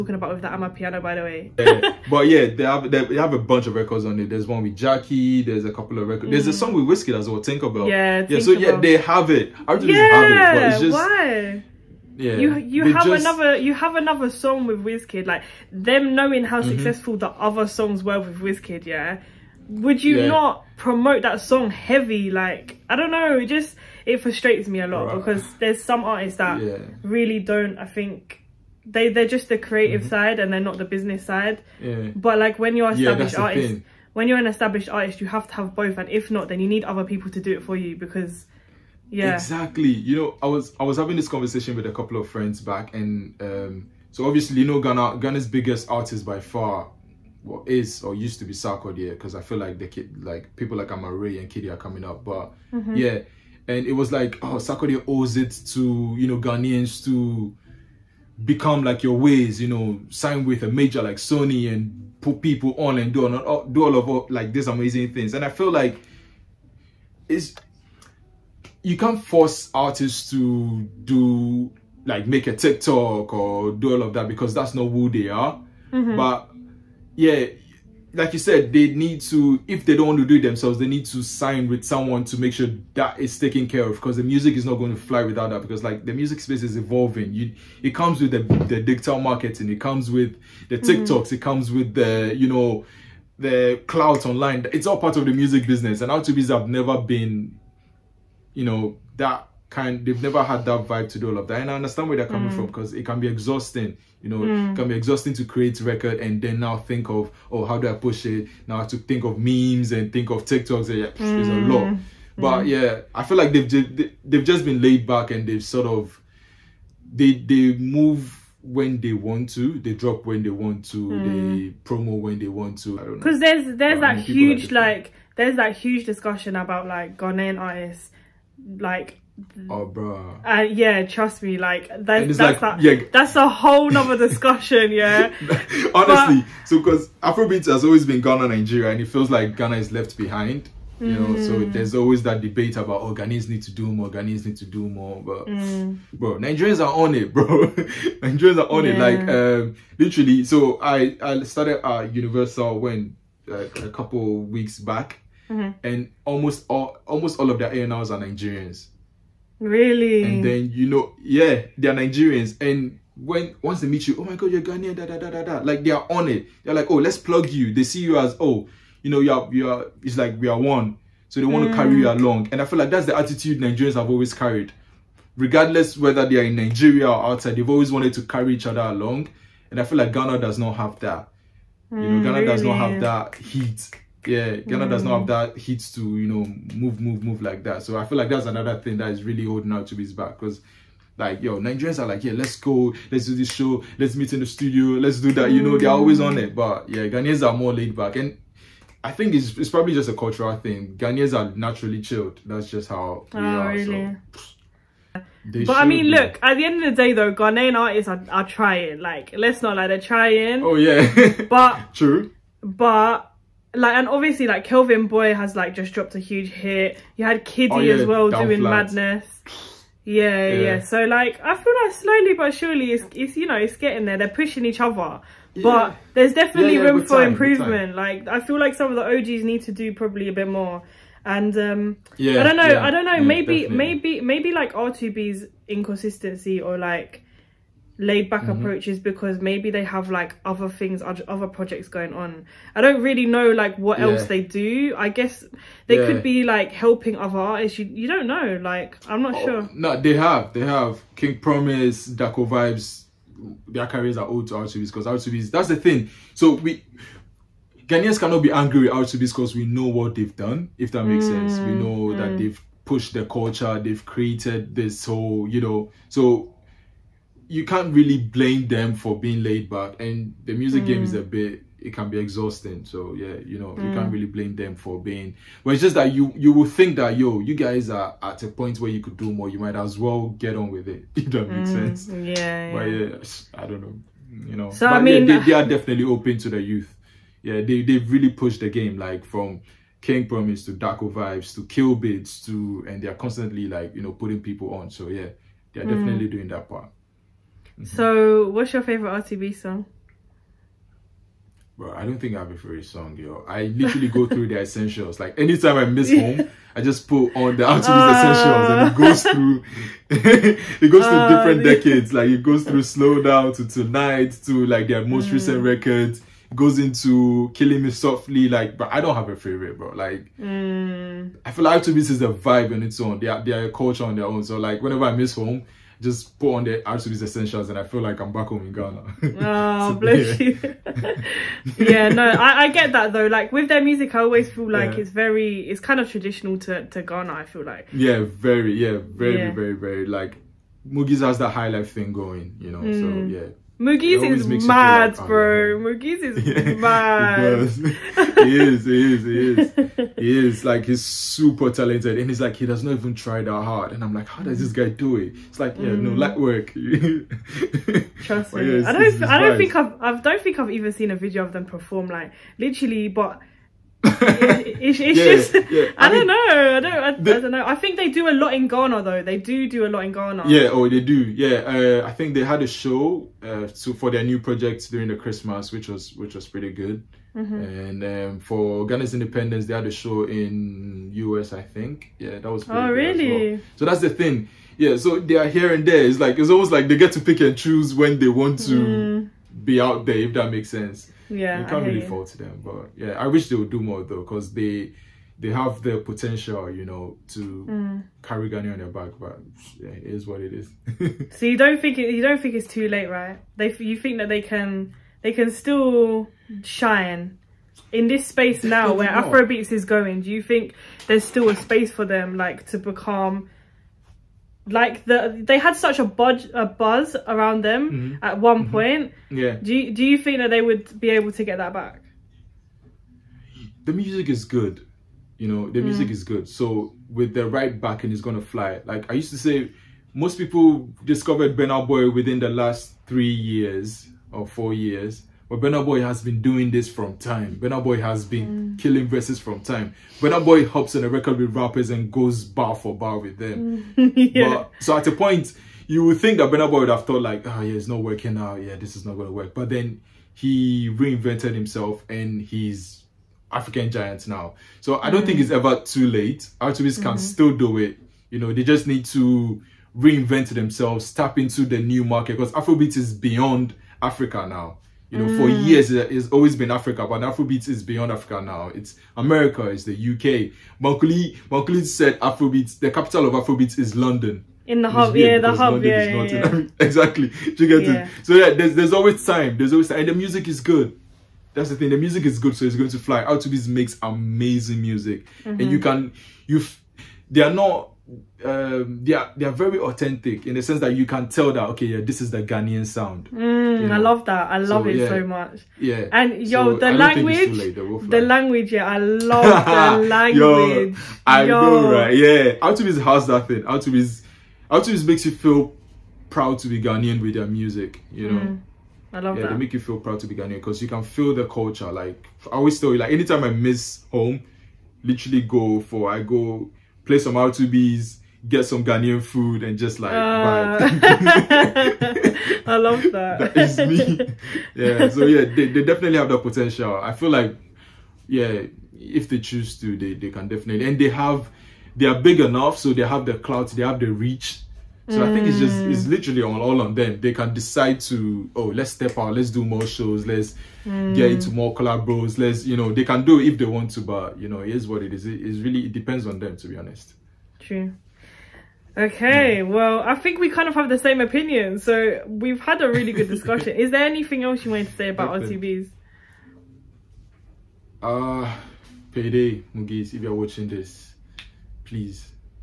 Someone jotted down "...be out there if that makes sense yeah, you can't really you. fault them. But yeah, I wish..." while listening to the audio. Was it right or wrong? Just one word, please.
right.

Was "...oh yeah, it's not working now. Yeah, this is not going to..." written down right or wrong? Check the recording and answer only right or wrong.
right.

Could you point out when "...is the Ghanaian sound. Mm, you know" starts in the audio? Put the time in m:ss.
8:12.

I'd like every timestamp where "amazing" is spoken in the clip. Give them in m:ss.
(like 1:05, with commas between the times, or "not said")
1:04, 8:04.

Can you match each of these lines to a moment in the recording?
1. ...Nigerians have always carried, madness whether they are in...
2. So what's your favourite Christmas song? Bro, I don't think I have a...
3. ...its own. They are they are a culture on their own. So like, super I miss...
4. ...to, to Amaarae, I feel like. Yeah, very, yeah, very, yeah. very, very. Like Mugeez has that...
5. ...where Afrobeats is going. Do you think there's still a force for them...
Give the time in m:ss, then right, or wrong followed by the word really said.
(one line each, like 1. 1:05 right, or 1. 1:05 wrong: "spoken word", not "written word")
1. 2:53 wrong: "regardless", not "madness"
2. 4:57 wrong: "RTB", not "Christmas"
3. 5:22 wrong: "whenever", not "super"
4. 5:36 wrong: "Ghana", not "Amaarae"
5. 6:48 wrong: "space", not "force".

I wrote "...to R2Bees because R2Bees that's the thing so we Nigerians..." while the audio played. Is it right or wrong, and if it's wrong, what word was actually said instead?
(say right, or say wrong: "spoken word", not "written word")
wrong: "Ghanaians", not "Nigerians".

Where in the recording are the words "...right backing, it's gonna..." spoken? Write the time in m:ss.
7:07.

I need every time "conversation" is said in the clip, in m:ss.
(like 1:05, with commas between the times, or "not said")
0:41.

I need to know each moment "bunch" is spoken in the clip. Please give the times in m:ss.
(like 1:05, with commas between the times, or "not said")
0:03.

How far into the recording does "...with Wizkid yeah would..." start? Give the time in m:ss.
0:18.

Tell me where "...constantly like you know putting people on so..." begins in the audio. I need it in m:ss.
4:53.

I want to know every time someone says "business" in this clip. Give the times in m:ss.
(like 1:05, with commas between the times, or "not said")
0:30, 1:35.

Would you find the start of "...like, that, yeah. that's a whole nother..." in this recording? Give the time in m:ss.
2:12.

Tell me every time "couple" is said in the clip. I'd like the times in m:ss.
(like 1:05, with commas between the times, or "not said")
0:05, 0:41, 2:33.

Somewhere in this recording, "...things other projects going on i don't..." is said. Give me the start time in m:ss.
4:00.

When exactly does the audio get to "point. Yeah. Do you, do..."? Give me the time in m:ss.
6:58.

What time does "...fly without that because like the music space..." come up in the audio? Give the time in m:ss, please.
1:25.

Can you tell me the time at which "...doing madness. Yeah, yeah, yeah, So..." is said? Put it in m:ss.
3:38.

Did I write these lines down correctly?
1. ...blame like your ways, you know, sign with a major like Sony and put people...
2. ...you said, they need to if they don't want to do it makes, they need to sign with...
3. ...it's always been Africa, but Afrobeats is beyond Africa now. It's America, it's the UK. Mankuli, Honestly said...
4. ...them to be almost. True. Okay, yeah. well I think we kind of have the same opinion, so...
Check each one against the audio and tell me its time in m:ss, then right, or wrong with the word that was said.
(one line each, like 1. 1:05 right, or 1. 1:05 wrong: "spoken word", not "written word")
1. 0:58 wrong: "become", not "blame"
2. 1:18 wrong: "themselves", not "makes"
3. 7:46 wrong: "Mankuli", not "Honestly"
4. 9:06 wrong: "honest", not "almost".